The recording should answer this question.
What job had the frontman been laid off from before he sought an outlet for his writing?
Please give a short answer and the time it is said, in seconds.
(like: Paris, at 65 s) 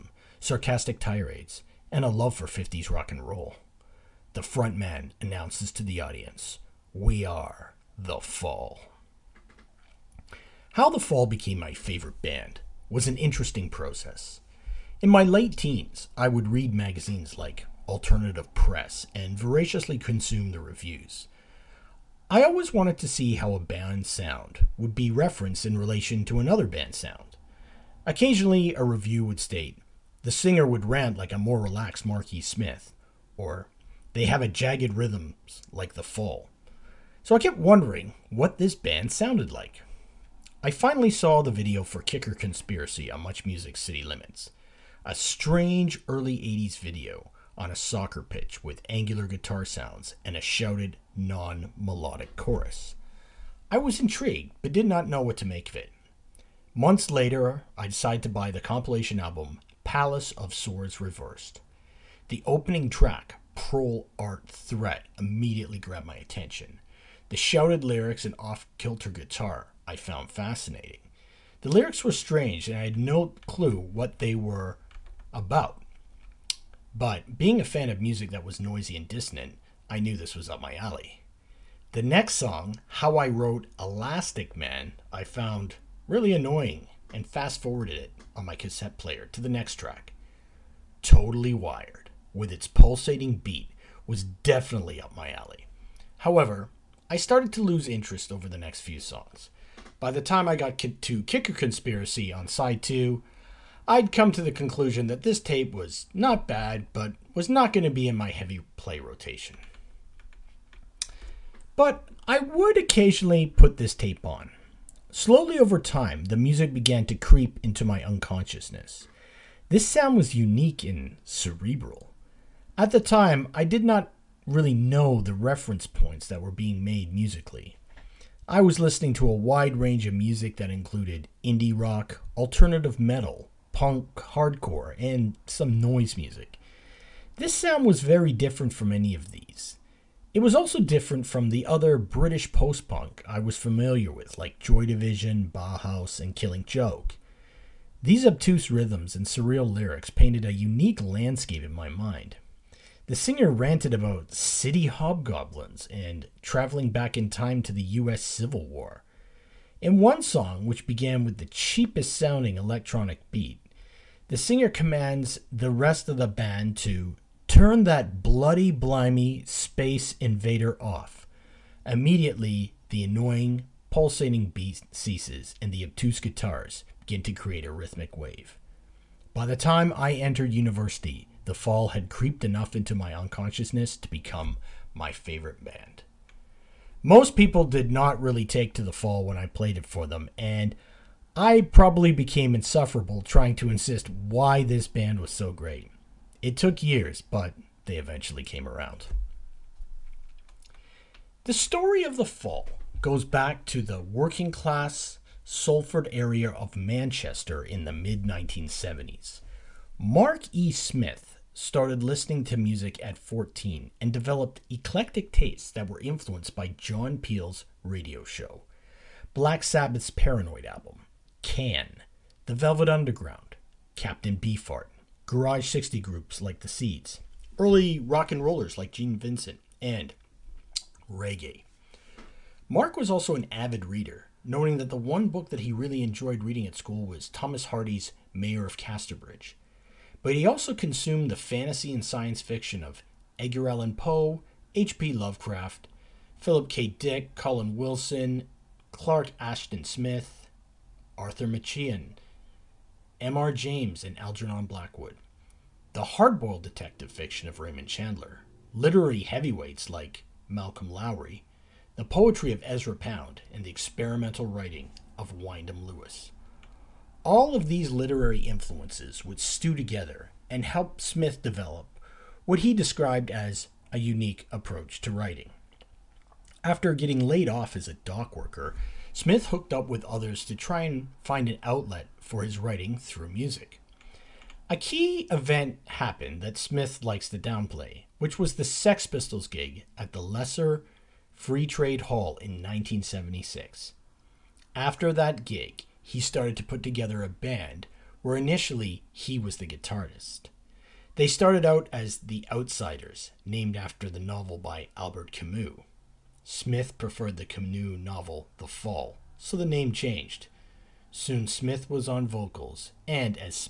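Dock worker, at 277 s.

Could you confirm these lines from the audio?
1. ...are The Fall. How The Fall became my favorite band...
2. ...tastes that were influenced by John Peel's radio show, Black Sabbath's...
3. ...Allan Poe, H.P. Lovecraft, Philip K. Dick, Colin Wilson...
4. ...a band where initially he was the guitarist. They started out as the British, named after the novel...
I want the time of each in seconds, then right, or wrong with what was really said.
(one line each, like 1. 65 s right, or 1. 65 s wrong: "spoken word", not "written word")
1. 7 s right
2. 215 s right
3. 243 s right
4. 297 s wrong: "Outsiders", not "British".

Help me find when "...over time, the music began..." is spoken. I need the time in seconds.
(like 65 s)
115 s.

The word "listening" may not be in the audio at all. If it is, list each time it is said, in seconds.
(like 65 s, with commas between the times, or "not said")
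128 s, 212 s.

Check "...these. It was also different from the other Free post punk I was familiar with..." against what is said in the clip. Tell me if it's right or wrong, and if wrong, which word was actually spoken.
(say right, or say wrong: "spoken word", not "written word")
wrong: "British", not "Free".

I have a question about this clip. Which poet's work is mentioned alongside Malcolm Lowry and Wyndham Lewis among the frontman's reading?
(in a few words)
Ezra Pound.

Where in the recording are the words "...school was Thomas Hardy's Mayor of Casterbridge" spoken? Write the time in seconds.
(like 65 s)
236 s.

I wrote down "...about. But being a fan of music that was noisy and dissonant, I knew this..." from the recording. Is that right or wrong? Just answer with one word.
right.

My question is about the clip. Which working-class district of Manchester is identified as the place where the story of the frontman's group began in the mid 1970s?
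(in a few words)
Salford.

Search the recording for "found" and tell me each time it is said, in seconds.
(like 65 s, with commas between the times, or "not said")
69 s, 85 s.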